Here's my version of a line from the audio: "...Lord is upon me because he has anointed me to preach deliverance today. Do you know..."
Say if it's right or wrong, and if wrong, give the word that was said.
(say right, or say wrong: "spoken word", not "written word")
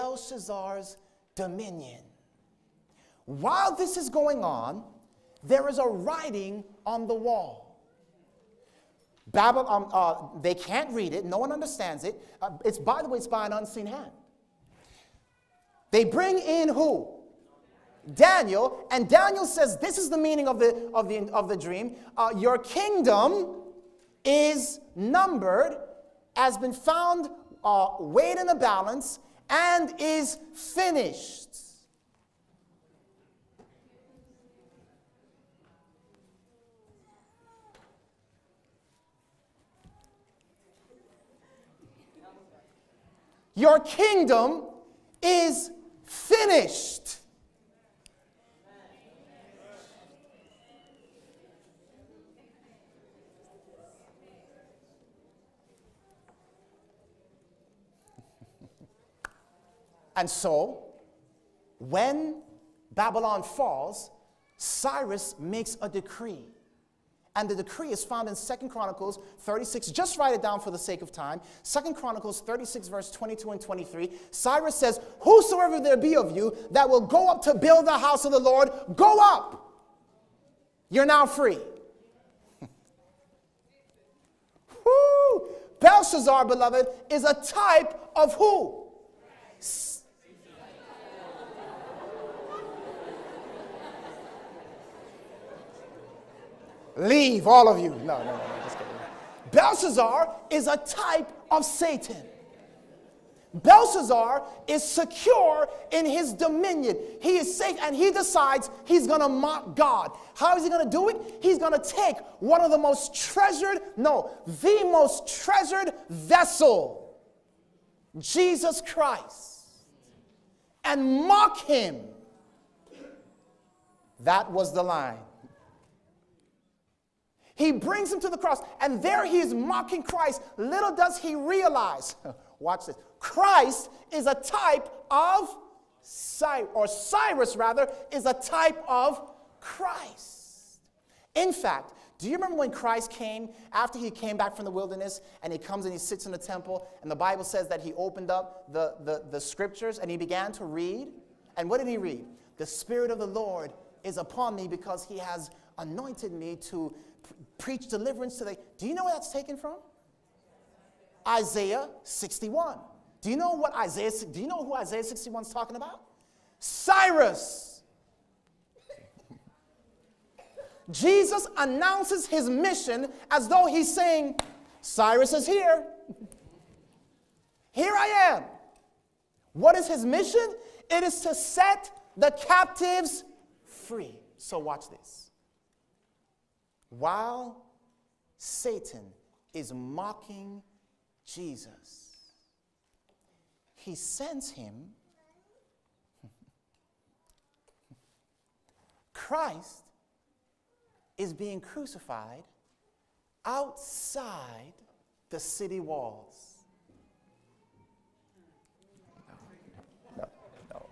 right.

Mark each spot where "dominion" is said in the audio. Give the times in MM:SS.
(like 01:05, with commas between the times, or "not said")
00:01, 01:46.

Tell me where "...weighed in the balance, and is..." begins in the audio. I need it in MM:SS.
00:27.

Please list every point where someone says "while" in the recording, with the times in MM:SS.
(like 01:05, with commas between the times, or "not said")
00:03, 03:06.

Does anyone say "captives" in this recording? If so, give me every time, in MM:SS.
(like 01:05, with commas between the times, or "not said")
03:02.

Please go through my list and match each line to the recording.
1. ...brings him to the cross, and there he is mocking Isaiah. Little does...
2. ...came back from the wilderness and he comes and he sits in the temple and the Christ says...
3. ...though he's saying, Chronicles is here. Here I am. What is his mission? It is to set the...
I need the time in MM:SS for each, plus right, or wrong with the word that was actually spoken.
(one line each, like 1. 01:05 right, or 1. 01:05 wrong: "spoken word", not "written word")
1. 02:07 wrong: "Christ", not "Isaiah"
2. 02:24 wrong: "Bible", not "Christ"
3. 02:53 wrong: "Cyrus", not "Chronicles".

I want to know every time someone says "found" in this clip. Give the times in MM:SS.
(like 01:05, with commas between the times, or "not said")
00:26, 01:08.